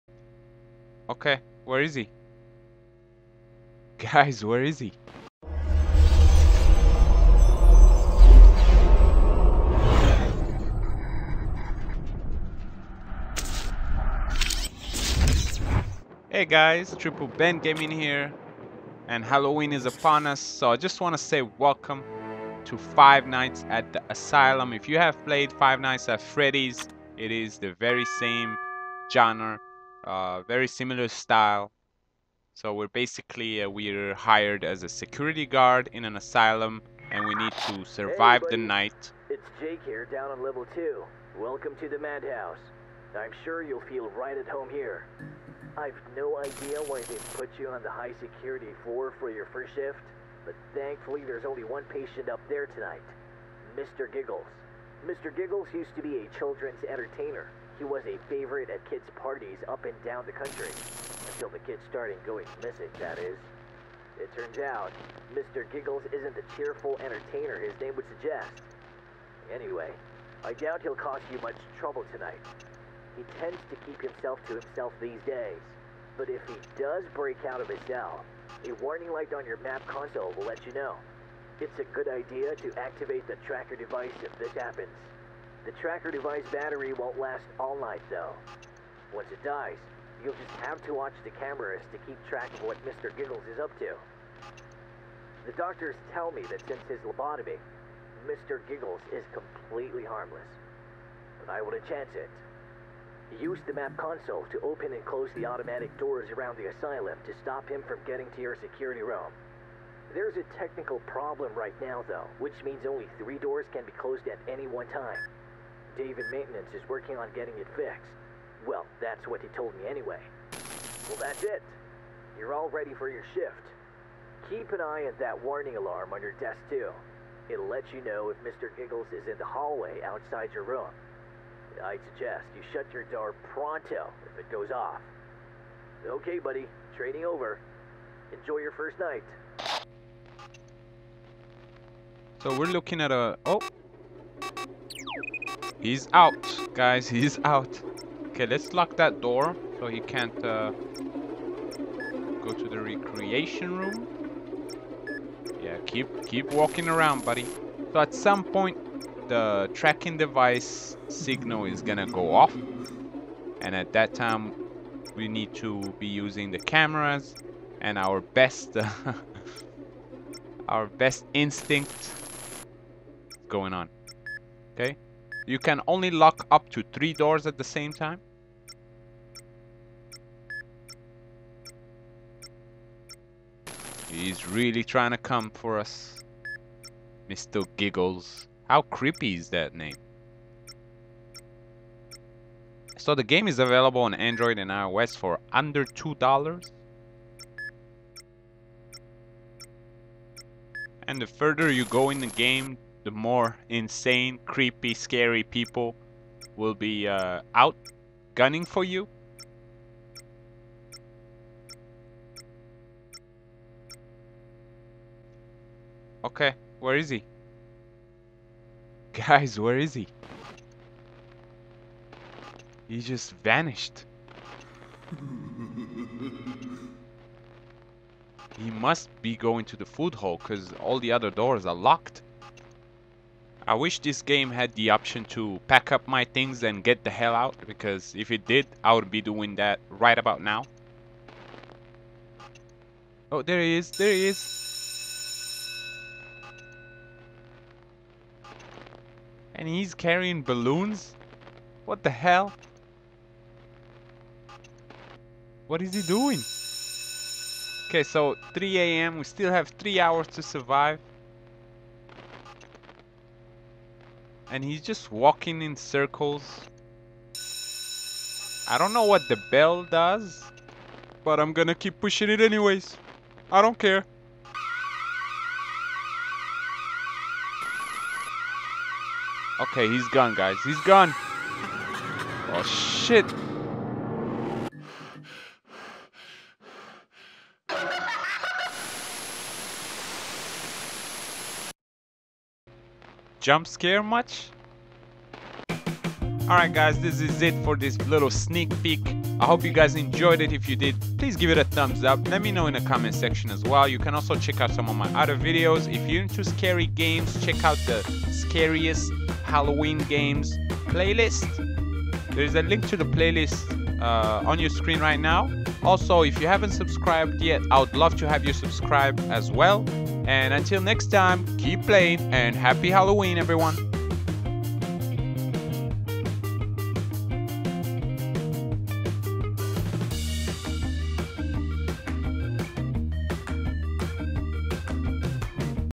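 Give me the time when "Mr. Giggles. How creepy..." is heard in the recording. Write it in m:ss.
3:07.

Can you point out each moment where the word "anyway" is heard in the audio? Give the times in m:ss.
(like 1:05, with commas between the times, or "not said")
1:09, 1:59, 4:32.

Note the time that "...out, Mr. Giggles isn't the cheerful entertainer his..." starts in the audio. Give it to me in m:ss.
1:04.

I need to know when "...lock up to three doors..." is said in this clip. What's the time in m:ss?
2:56.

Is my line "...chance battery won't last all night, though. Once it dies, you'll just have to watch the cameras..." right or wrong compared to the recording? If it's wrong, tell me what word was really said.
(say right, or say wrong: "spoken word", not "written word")
wrong: "device", not "chance".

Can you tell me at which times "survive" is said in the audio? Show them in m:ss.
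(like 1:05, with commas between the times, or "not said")
0:37, 4:20.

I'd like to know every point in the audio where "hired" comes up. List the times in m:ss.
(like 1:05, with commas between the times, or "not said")
0:34.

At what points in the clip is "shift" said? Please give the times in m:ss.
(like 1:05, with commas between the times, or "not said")
0:49, 2:03.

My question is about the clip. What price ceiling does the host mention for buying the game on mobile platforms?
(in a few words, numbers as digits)
Under $2.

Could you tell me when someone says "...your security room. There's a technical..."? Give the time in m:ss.
1:48.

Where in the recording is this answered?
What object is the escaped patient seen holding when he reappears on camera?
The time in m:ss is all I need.
4:10.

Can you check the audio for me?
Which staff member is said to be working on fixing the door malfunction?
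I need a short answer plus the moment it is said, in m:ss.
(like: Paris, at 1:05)
David, at 1:55.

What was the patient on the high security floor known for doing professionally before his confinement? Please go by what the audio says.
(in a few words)
Children's entertainer.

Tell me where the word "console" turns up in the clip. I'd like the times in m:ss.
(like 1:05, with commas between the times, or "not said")
1:19, 1:43.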